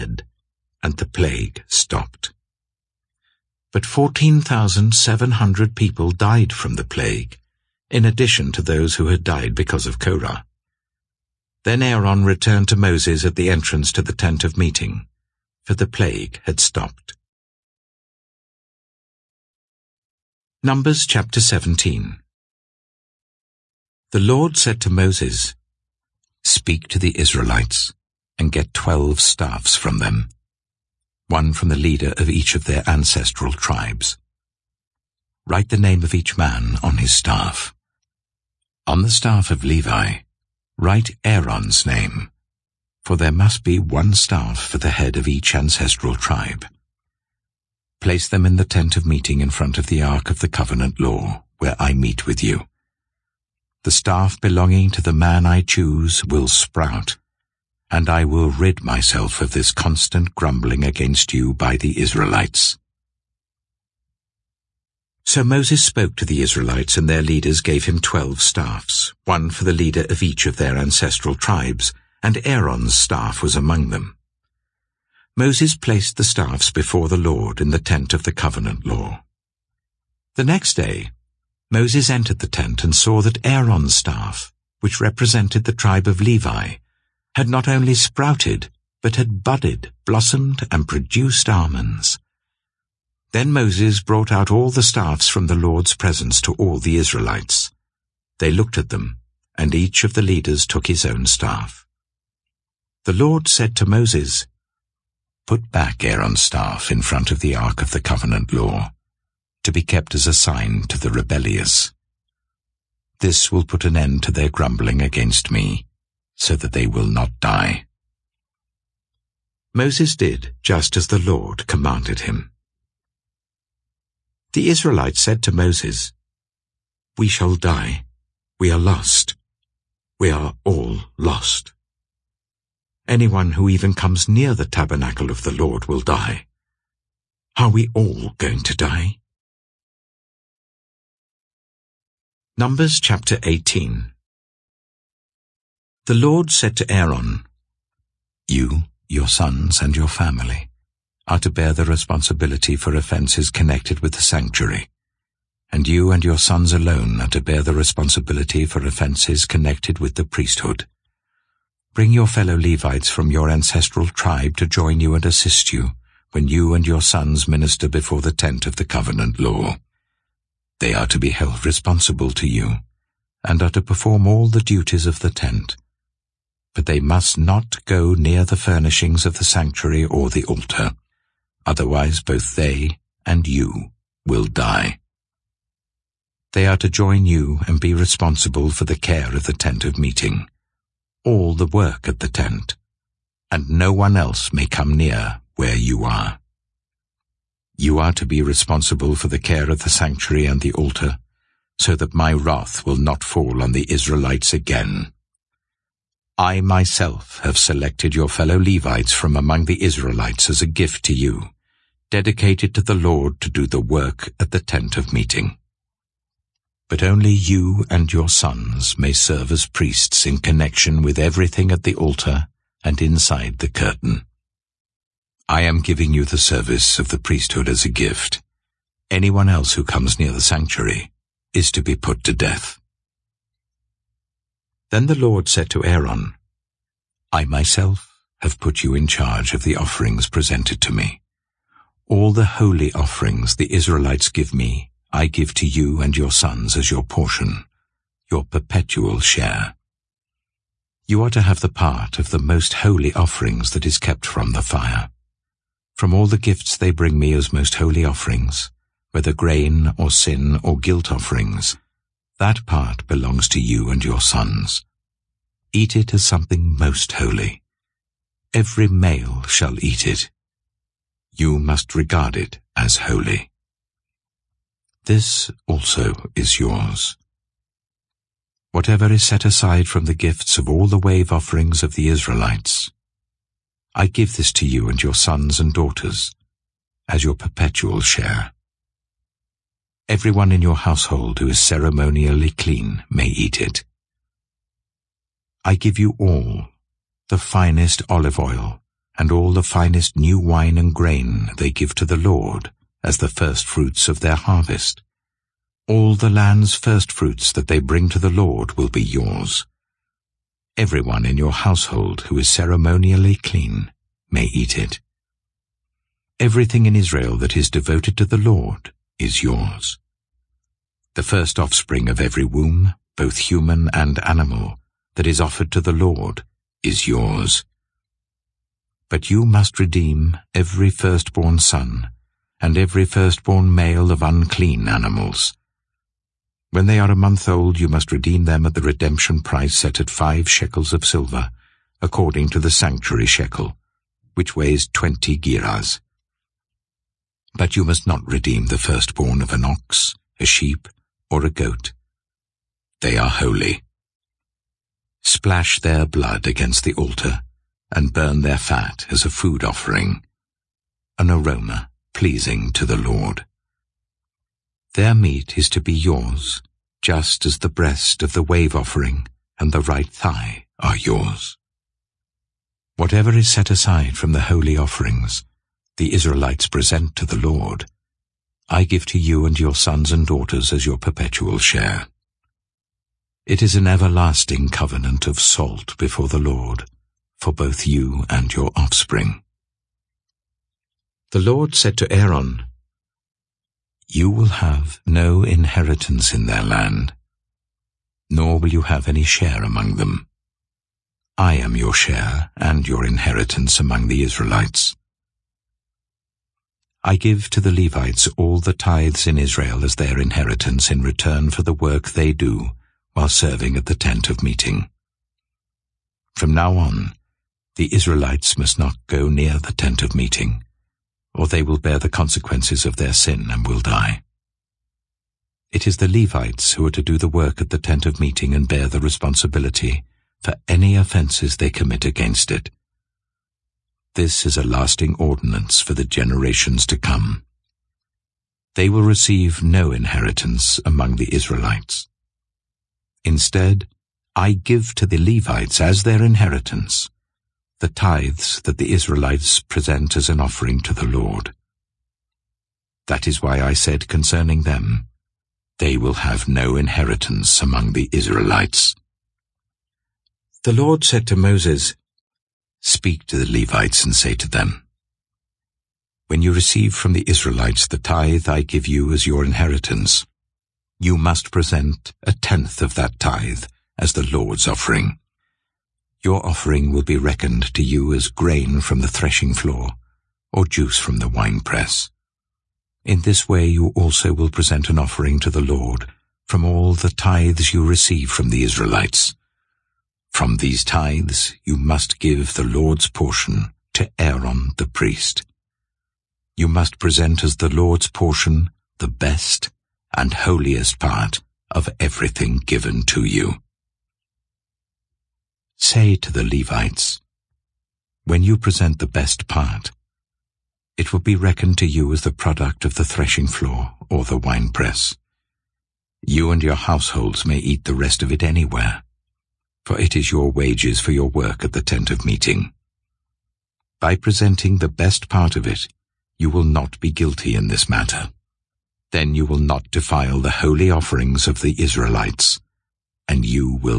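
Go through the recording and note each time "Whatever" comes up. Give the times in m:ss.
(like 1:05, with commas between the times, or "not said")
4:38, 6:12.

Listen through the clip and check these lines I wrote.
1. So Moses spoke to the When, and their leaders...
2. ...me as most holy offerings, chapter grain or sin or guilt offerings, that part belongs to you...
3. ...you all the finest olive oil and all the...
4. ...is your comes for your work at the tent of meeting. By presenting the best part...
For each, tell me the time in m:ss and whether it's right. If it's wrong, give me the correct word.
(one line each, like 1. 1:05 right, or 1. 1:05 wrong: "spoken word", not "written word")
1. 1:05 wrong: "Israelites", not "When"
2. 4:17 wrong: "whether", not "chapter"
3. 4:55 right
4. 8:40 wrong: "wages", not "comes".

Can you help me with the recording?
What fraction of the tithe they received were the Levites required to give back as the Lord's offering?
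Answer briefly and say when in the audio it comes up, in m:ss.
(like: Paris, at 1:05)
a tenth, at 7:52.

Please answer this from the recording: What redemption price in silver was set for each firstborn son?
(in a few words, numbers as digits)
5 shekels.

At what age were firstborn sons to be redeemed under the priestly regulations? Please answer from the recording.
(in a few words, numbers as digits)
a month old.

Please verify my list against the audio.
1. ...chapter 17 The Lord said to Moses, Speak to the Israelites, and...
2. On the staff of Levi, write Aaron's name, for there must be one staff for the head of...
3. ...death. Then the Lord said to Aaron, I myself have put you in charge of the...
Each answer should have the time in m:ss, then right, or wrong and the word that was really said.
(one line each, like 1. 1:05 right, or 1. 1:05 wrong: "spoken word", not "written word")
1. 0:21 right
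2. 0:38 right
3. 3:52 right.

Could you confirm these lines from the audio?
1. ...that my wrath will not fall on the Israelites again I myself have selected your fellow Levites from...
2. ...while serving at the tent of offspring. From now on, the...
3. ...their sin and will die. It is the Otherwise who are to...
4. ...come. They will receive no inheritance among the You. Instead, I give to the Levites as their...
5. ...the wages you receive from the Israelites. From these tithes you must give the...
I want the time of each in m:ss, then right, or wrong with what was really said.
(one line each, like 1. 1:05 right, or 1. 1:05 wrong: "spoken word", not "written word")
1. 3:21 right
2. 6:53 wrong: "meeting", not "offspring"
3. 7:02 wrong: "Levites", not "Otherwise"
4. 7:16 wrong: "Israelites", not "You"
5. 8:06 wrong: "tithes", not "wages".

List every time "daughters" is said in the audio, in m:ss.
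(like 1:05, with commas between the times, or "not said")
4:45, 6:20.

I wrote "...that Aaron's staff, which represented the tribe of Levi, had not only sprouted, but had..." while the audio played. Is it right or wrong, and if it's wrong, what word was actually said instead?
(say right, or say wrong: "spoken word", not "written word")
right.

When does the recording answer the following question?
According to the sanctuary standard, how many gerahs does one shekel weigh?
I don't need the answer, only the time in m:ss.
5:44.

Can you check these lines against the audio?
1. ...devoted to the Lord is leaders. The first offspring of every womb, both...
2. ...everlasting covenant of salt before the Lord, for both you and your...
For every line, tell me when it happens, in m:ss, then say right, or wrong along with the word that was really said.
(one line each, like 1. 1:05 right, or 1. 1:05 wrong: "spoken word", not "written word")
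1. 5:17 wrong: "yours", not "leaders"
2. 6:23 right.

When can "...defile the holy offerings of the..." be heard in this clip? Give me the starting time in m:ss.
8:49.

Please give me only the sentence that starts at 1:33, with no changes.
Then Moses brought out all the staffs from the Lord's presence to all the Israelites.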